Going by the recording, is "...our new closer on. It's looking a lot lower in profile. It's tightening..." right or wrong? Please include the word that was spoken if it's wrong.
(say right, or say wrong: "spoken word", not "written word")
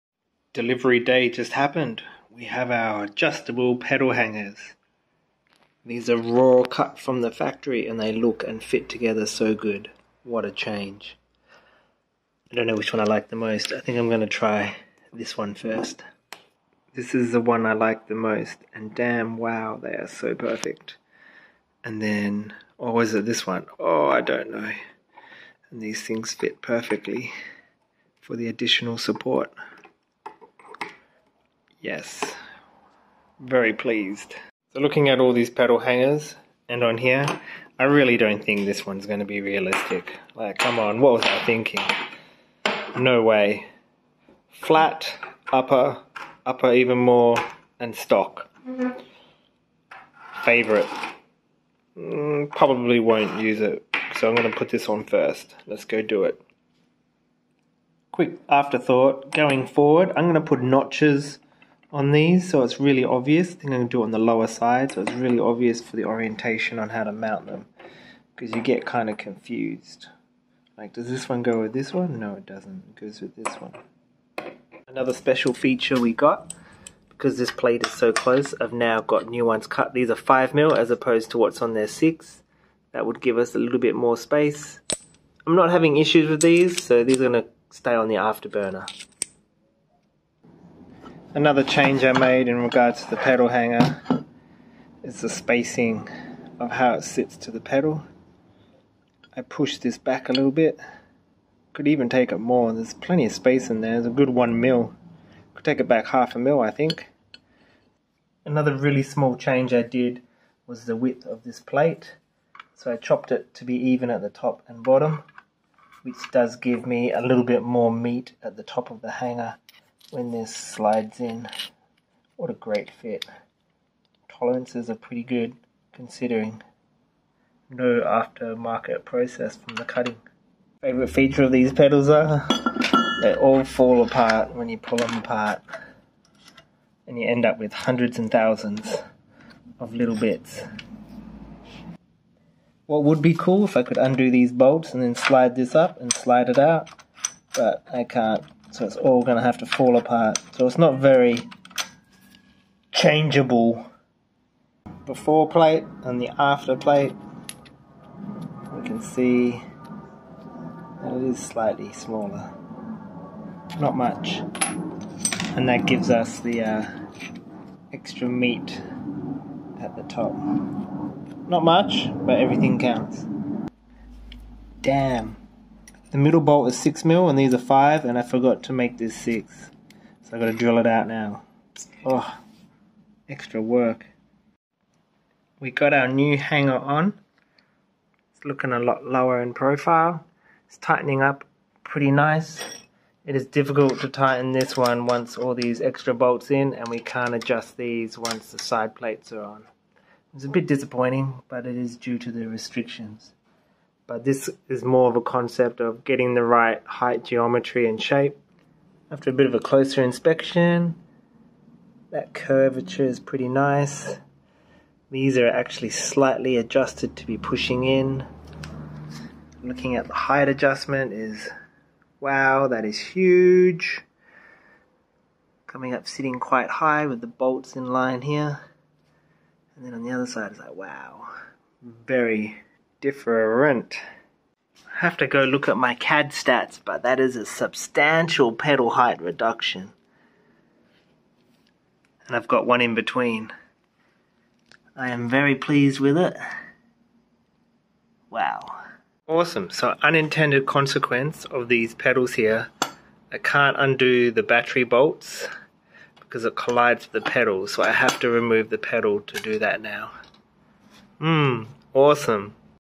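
wrong: "hanger", not "closer".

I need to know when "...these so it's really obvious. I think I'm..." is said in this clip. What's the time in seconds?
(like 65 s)
62 s.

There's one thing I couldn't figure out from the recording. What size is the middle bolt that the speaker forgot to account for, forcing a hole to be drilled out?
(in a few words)
6 mil.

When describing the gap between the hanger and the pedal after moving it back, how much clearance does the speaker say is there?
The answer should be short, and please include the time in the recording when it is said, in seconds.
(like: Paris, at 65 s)
1 mil, at 104 s.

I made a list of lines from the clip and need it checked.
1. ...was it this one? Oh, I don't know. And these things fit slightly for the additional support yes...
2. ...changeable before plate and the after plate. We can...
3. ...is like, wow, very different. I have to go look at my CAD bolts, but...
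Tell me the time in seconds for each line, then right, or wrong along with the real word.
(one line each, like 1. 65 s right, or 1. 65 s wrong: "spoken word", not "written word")
1. 22 s wrong: "perfectly", not "slightly"
2. 152 s right
3. 230 s wrong: "stats", not "bolts".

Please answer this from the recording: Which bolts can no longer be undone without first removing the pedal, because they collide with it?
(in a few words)
battery bolts.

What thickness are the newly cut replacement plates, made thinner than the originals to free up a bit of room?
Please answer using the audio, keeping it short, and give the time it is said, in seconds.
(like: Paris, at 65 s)
5mm, at 79 s.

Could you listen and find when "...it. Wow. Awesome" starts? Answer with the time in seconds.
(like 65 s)
246 s.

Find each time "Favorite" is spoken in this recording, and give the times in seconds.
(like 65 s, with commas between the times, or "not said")
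50 s, 130 s.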